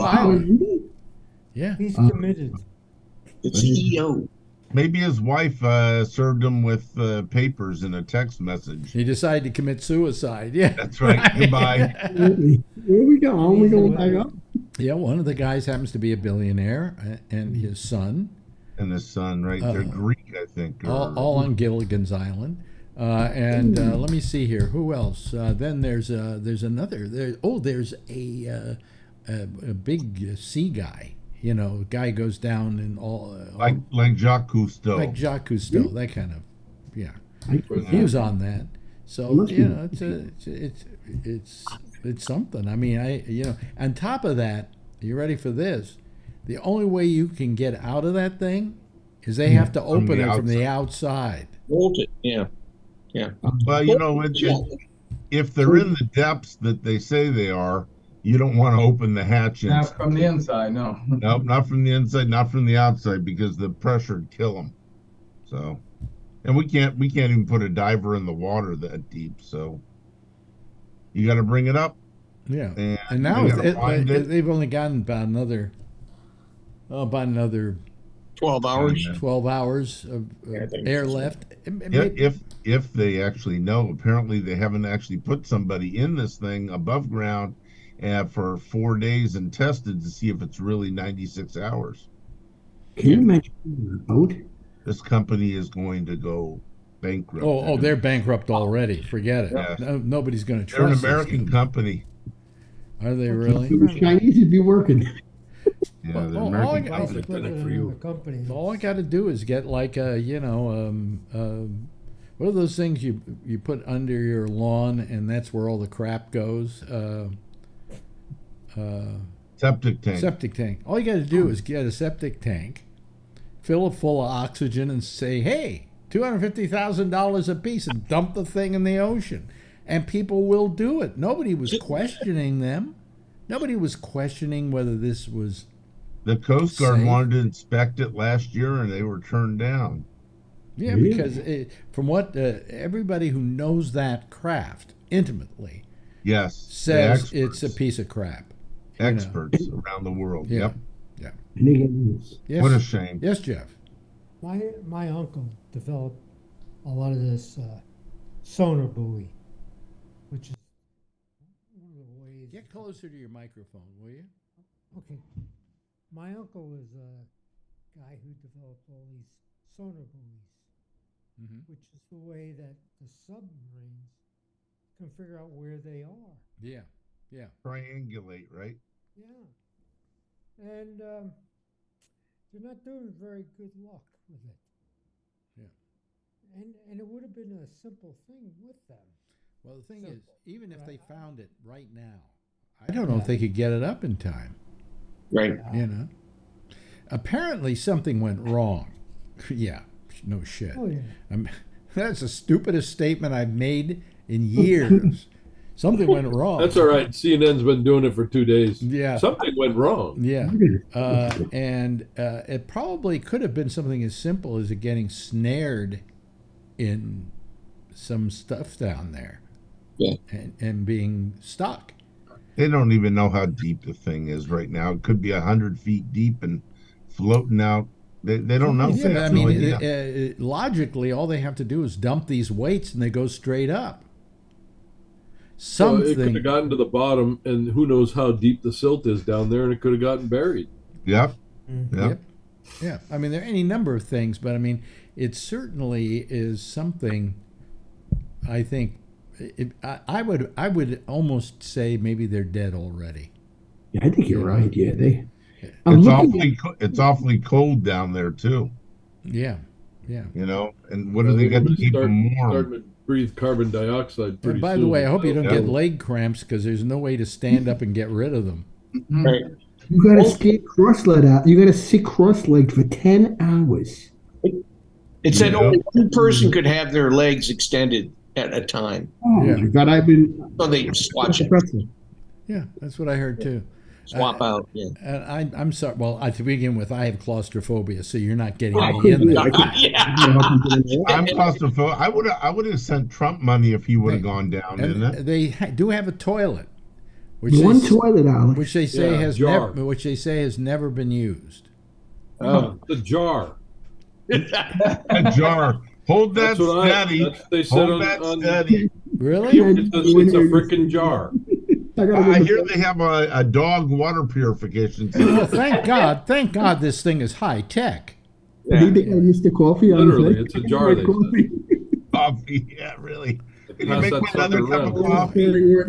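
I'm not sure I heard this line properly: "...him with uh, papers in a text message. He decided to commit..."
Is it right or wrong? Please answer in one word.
right.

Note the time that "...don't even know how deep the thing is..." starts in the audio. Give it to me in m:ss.
3:42.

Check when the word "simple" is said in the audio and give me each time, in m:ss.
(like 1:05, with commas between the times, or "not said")
3:07, 3:34.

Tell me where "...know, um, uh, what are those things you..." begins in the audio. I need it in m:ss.
1:50.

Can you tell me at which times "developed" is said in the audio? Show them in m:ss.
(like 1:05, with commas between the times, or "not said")
2:35, 2:48.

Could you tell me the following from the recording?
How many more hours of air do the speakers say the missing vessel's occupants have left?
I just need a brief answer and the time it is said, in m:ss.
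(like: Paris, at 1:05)
12, at 1:19.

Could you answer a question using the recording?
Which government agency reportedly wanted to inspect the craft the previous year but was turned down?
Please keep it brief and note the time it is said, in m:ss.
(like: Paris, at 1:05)
The Coast Guard, at 2:16.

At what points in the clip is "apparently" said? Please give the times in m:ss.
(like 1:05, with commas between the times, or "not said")
1:23, 3:17.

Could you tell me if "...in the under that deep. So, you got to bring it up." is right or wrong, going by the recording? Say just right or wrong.
wrong.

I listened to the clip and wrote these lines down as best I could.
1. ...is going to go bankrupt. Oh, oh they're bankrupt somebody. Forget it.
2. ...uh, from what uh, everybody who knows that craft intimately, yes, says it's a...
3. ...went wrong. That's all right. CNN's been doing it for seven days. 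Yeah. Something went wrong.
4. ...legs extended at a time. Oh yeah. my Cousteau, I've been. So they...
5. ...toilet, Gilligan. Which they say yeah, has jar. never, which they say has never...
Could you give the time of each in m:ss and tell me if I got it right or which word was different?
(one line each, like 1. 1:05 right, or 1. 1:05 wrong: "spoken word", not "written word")
1. 1:35 wrong: "already", not "somebody"
2. 2:21 right
3. 3:26 wrong: "two", not "seven"
4. 4:37 wrong: "God", not "Cousteau"
5. 4:57 wrong: "Alex", not "Gilligan".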